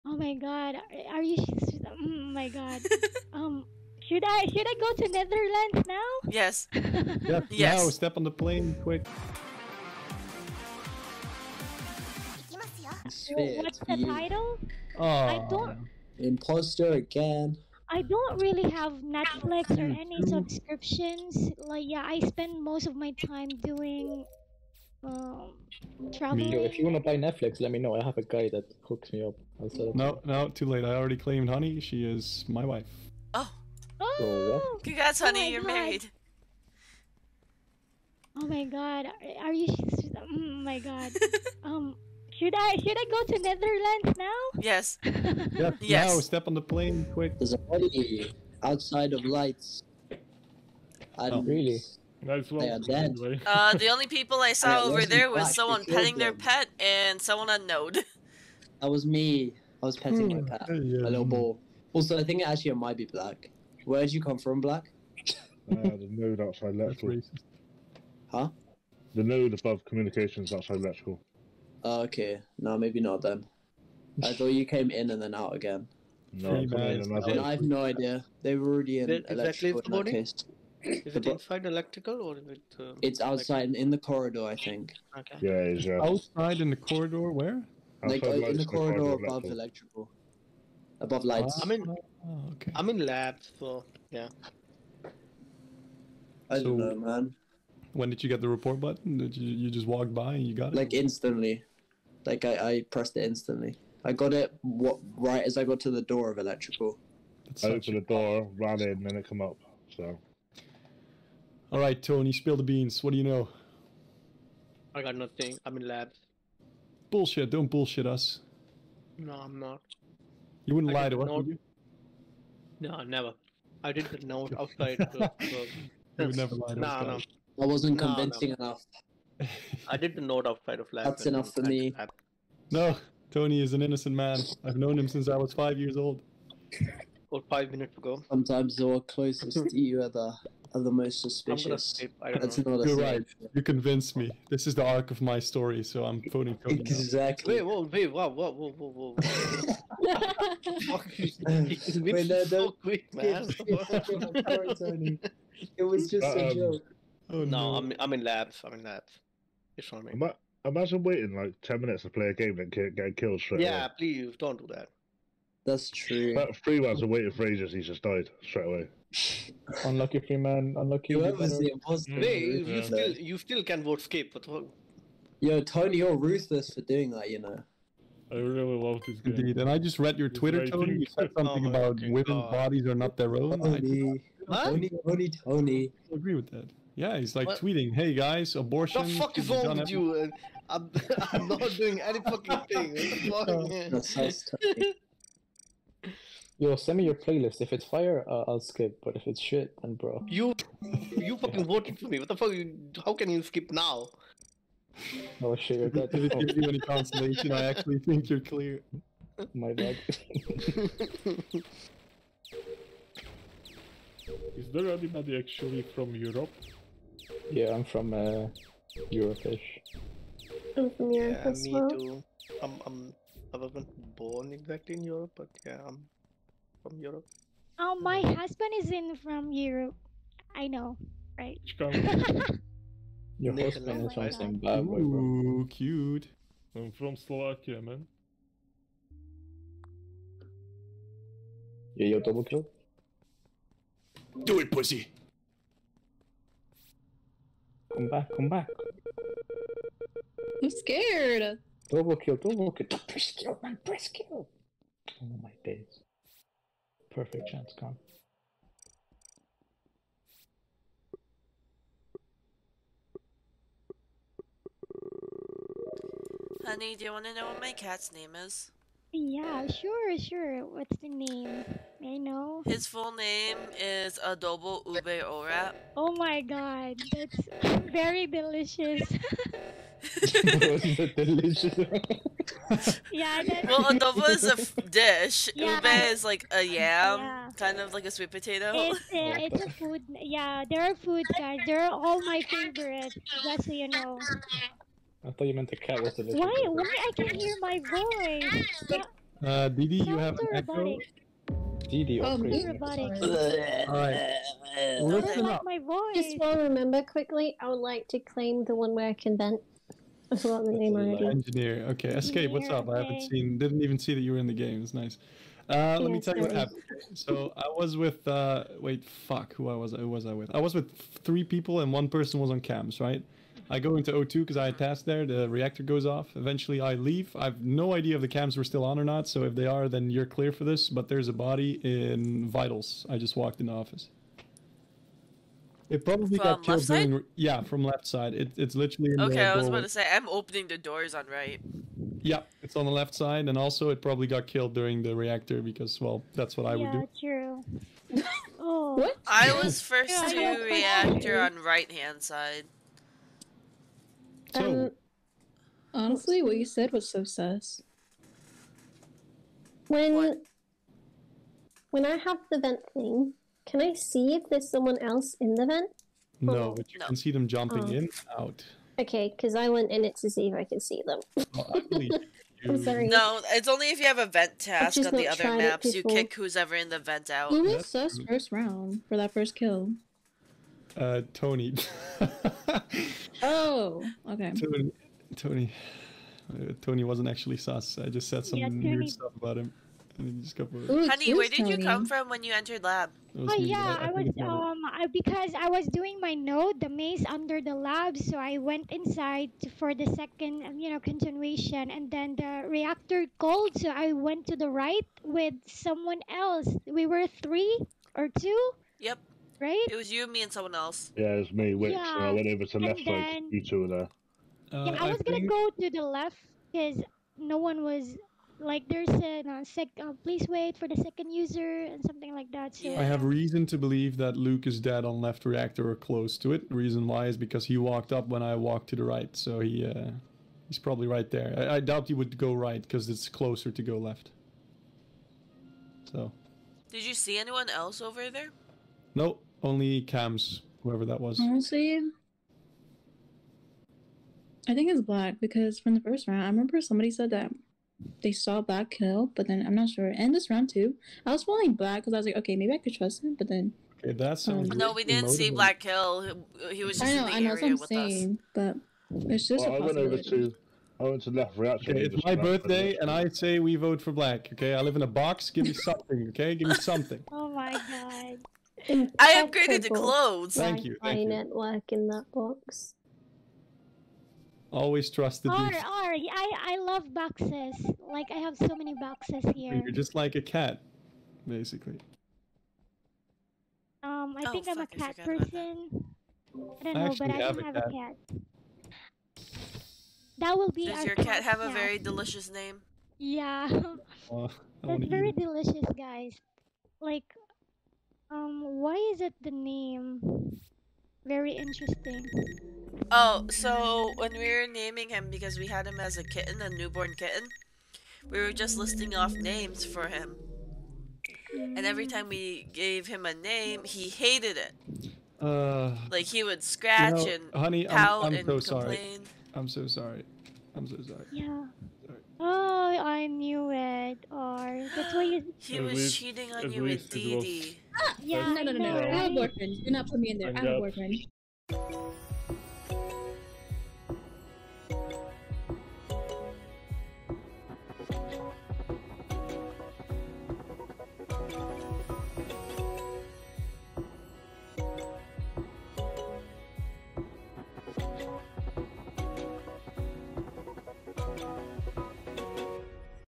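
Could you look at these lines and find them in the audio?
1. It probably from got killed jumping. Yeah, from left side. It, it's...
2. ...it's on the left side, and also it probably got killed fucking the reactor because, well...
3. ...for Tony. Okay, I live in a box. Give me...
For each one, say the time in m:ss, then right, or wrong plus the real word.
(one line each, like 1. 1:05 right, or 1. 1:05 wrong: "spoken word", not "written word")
1. 5:35 wrong: "during", not "jumping"
2. 5:42 wrong: "during", not "fucking"
3. 7:43 wrong: "Black", not "Tony".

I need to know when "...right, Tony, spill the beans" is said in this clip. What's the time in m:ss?
1:51.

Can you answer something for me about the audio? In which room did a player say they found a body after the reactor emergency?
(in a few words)
vitals.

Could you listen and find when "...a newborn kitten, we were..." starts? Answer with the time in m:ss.
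8:26.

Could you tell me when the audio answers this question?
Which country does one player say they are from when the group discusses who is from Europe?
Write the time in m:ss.
3:57.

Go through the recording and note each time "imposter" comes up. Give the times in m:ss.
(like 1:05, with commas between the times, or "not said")
0:16, 2:51.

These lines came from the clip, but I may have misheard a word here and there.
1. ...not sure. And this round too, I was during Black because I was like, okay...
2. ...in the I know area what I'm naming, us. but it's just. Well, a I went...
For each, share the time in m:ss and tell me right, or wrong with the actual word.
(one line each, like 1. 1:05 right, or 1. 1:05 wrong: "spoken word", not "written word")
1. 7:29 wrong: "following", not "during"
2. 7:37 wrong: "saying", not "naming".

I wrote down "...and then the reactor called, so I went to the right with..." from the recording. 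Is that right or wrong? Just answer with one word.
right.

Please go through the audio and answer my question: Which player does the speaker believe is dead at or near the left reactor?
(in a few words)
Luke.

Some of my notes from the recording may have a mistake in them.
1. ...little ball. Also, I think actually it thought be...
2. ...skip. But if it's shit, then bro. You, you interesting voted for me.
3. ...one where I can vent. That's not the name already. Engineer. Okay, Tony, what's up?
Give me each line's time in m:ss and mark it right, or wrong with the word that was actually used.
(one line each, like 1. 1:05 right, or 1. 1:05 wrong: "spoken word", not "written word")
1. 1:00 wrong: "might", not "thought"
2. 3:18 wrong: "fucking", not "interesting"
3. 5:08 wrong: "Escape", not "Tony".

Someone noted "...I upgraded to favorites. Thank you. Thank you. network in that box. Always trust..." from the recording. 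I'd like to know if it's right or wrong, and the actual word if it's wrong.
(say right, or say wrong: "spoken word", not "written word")
wrong: "clothes", not "favorites".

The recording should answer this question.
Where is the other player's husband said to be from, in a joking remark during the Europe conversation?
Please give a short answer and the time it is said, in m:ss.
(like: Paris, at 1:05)
Zimbabwe, at 3:54.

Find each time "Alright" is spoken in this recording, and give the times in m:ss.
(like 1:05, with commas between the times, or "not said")
5:02.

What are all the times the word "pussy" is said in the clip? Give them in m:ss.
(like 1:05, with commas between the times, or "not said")
4:04.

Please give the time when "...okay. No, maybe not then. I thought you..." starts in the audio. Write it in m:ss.
1:12.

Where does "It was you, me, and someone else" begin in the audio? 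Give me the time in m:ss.
6:49.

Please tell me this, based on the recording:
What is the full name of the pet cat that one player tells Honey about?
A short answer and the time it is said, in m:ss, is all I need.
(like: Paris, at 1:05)
Adobo Ube Ora, at 4:34.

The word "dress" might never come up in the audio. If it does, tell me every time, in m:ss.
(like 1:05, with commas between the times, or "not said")
not said.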